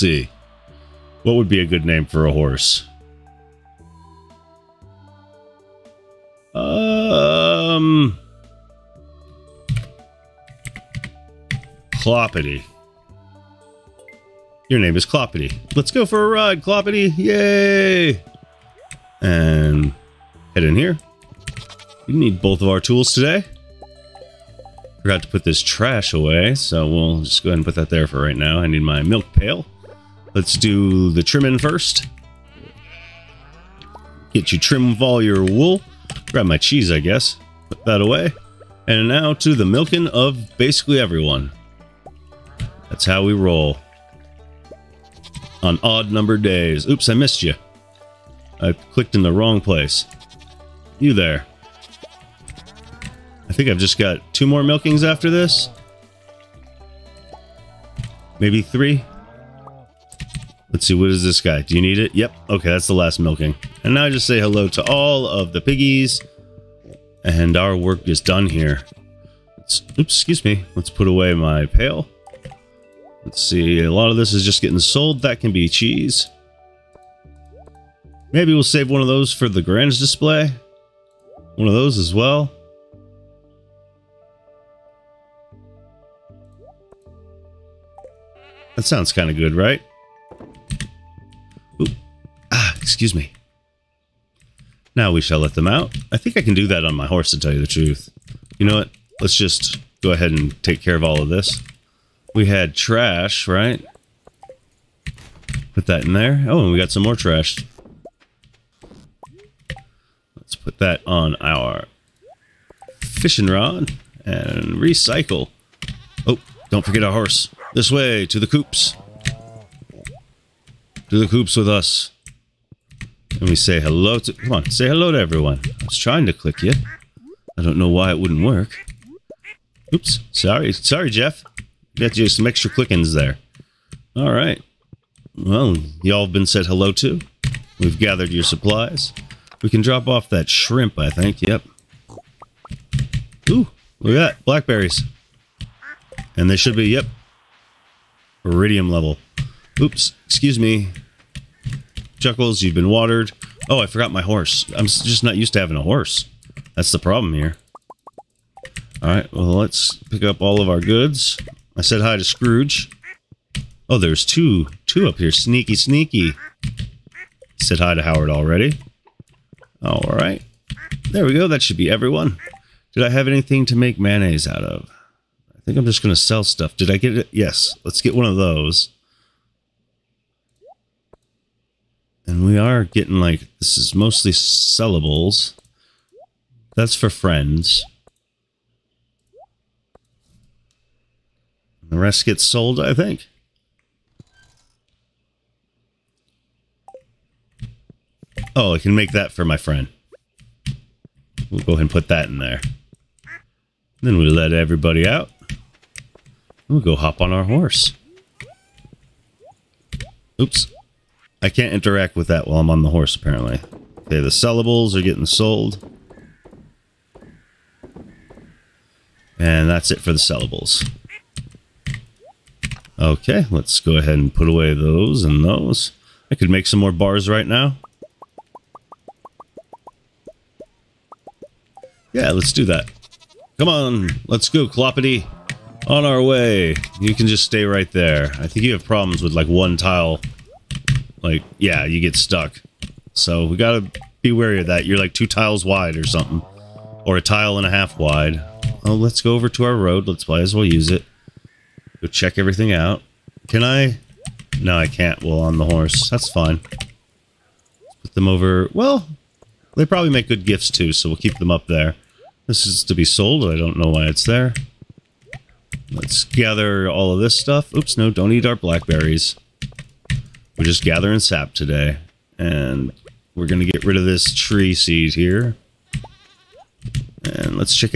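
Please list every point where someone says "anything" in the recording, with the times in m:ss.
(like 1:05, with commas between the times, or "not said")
2:53.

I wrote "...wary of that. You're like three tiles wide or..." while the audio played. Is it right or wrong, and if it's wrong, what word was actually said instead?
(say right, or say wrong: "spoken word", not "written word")
wrong: "two", not "three".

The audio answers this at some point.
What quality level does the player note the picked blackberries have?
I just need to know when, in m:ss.
2:28.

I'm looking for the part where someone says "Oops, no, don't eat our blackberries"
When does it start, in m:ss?
4:27.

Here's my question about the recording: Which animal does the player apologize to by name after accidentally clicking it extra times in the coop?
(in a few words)
Jeff.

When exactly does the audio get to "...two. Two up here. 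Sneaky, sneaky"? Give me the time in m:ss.
2:44.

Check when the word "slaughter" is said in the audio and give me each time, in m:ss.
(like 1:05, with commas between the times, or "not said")
not said.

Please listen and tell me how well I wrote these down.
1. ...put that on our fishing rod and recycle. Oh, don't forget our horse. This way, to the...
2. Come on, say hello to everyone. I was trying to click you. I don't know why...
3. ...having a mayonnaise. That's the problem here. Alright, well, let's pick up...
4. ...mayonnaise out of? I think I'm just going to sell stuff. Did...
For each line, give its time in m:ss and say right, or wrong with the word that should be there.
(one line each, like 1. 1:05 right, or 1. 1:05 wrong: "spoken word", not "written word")
1. 1:50 right
2. 2:04 right
3. 2:35 wrong: "horse", not "mayonnaise"
4. 2:53 right.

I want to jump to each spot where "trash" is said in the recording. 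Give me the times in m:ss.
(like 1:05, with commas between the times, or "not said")
0:25, 1:42, 1:47.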